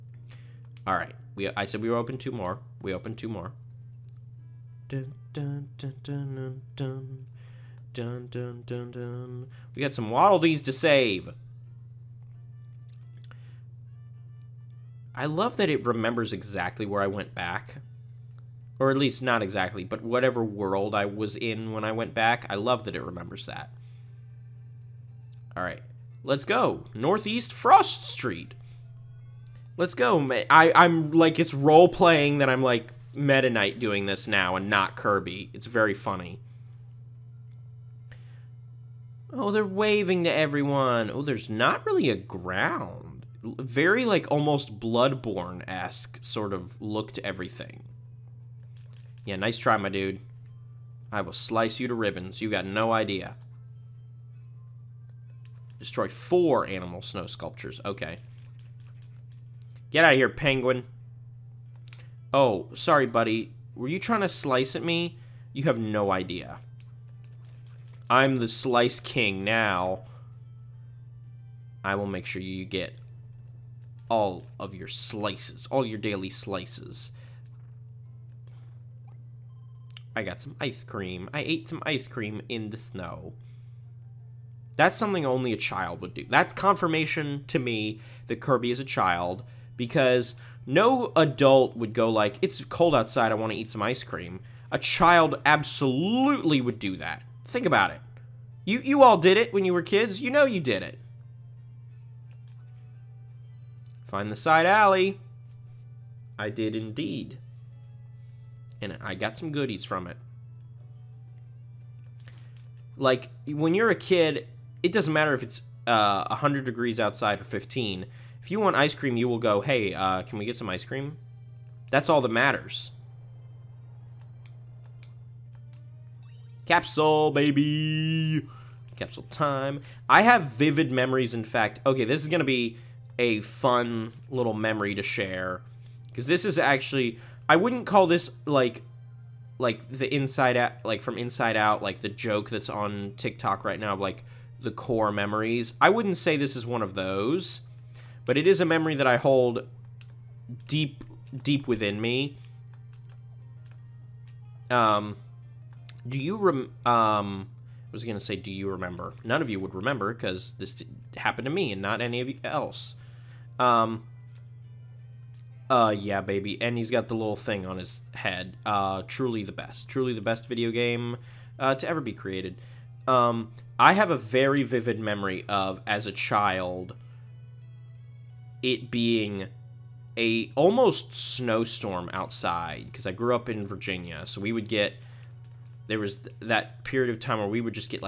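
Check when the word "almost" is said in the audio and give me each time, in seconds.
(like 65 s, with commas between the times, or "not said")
44 s, 180 s.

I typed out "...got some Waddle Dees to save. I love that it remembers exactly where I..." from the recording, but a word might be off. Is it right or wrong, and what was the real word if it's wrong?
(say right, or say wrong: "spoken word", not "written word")
right.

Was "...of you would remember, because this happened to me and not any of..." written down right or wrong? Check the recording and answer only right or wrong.
right.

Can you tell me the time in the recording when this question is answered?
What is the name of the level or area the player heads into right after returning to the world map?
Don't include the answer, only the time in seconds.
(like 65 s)
26 s.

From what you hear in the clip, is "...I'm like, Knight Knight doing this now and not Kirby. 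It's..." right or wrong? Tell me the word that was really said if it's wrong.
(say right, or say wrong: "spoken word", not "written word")
wrong: "Meta", not "Knight".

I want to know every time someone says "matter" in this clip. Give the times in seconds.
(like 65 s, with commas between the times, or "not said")
115 s, 122 s.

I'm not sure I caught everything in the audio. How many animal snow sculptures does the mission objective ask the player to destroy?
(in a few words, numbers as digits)
4.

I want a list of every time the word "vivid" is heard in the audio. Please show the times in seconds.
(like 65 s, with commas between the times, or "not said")
130 s, 174 s.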